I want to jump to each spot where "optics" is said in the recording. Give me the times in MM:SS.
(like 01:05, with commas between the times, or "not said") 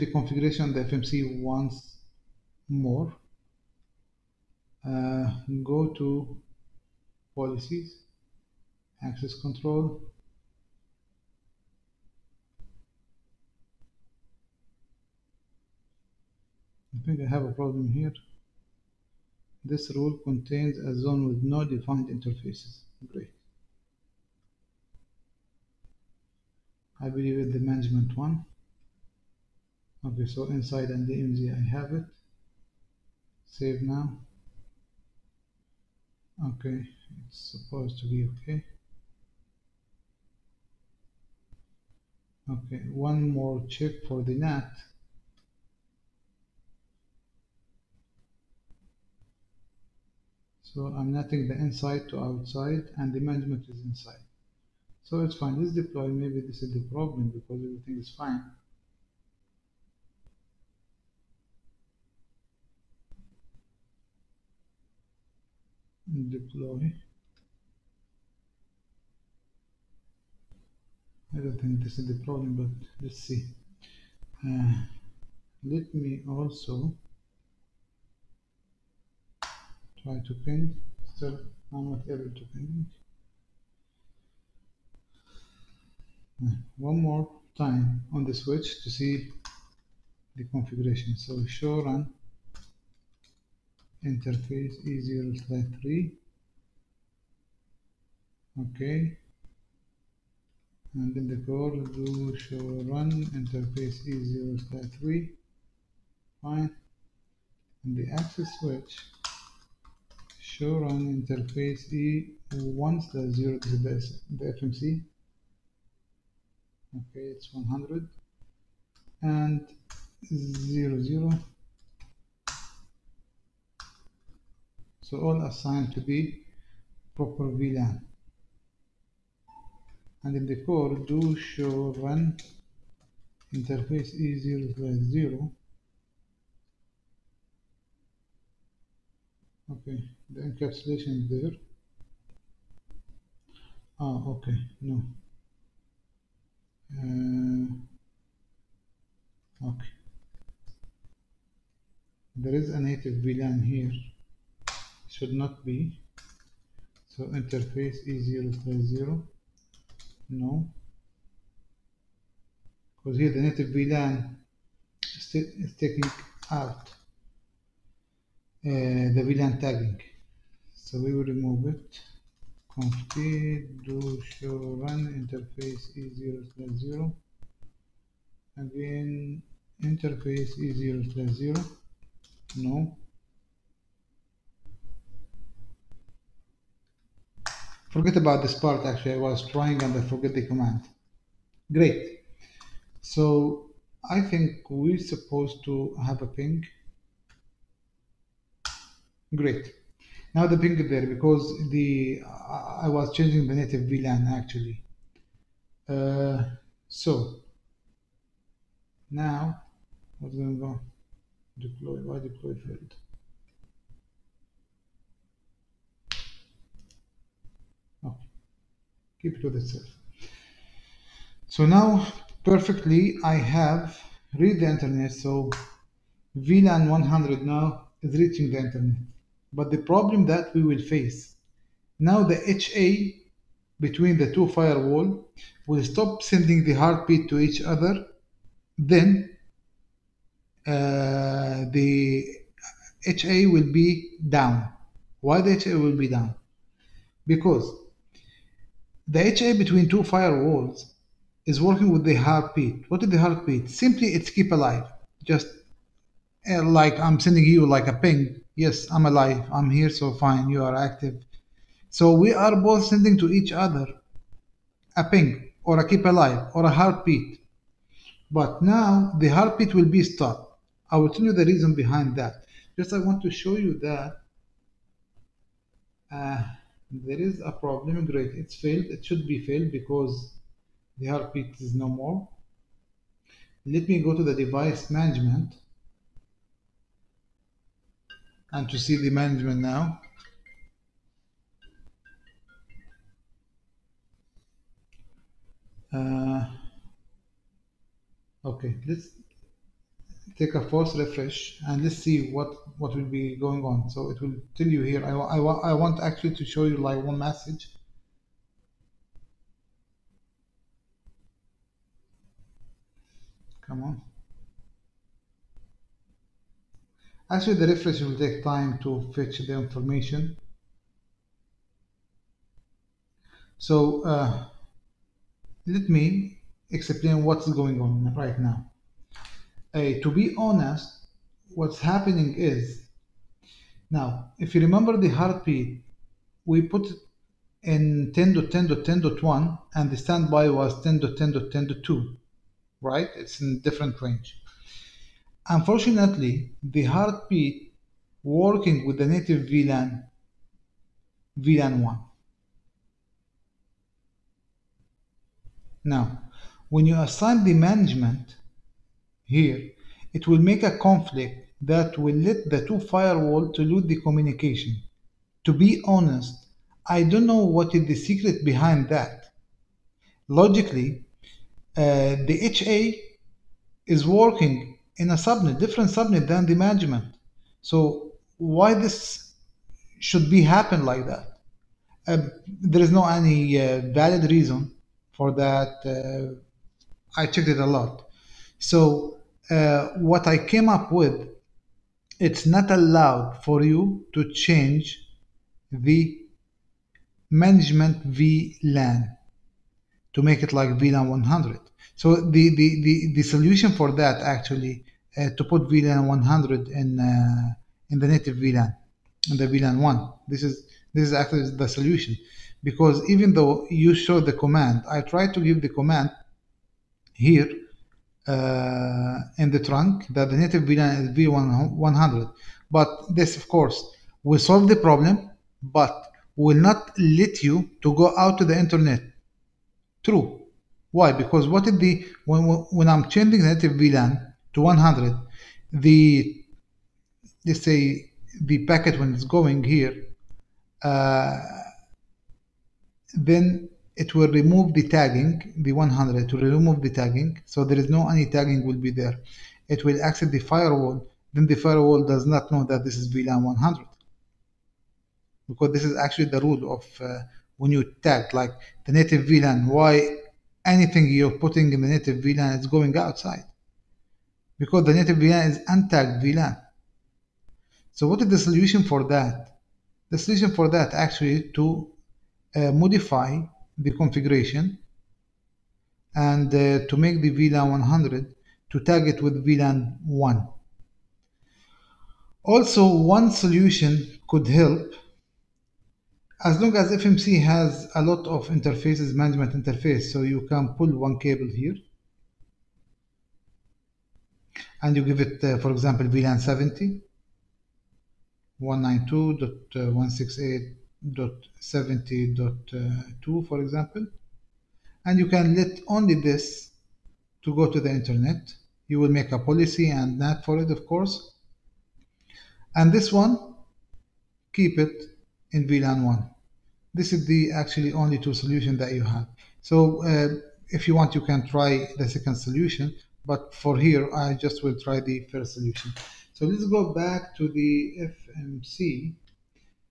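not said.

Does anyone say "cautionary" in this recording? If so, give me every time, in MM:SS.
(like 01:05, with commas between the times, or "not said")
not said.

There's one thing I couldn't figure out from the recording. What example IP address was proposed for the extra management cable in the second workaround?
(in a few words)
192.168.70.2.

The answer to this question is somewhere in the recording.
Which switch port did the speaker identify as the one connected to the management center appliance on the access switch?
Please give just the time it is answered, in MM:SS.
01:52.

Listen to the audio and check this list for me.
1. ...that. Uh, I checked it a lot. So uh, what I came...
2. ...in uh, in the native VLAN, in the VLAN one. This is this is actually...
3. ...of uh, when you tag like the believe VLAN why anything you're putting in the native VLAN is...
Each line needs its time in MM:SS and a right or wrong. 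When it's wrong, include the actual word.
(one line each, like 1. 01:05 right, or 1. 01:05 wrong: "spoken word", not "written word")
1. 06:25 right
2. 06:46 right
3. 07:36 wrong: "native", not "believe".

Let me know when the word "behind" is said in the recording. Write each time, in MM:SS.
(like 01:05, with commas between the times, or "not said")
04:31, 06:08.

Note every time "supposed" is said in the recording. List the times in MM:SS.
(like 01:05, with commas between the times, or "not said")
00:37, 03:14.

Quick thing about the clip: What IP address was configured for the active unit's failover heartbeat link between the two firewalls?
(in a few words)
10.10.10.1.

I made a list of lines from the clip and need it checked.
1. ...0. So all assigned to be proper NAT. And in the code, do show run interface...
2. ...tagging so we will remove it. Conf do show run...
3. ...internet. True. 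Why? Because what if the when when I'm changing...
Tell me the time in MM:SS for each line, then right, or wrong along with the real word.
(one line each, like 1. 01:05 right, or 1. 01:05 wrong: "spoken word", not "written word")
1. 02:01 wrong: "VLAN", not "NAT"
2. 02:49 right
3. 07:08 right.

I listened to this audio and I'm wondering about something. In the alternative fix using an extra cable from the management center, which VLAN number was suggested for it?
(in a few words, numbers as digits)
70.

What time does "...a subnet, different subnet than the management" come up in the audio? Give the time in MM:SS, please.
06:15.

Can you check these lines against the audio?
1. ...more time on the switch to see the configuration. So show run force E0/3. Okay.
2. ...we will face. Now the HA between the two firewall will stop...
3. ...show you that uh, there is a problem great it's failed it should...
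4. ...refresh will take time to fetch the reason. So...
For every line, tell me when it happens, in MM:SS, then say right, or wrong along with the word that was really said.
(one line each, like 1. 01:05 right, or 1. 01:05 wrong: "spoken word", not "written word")
1. 01:27 wrong: "interface", not "force"
2. 03:50 right
3. 04:33 right
4. 05:17 wrong: "information", not "reason".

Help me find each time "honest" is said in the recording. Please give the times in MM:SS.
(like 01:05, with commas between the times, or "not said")
05:30, 06:05.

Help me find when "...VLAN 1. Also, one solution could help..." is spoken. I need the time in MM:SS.
07:59.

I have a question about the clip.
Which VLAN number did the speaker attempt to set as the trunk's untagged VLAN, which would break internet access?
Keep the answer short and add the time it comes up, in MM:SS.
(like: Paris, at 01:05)
100, at 07:01.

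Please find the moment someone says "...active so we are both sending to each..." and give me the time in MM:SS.
04:20.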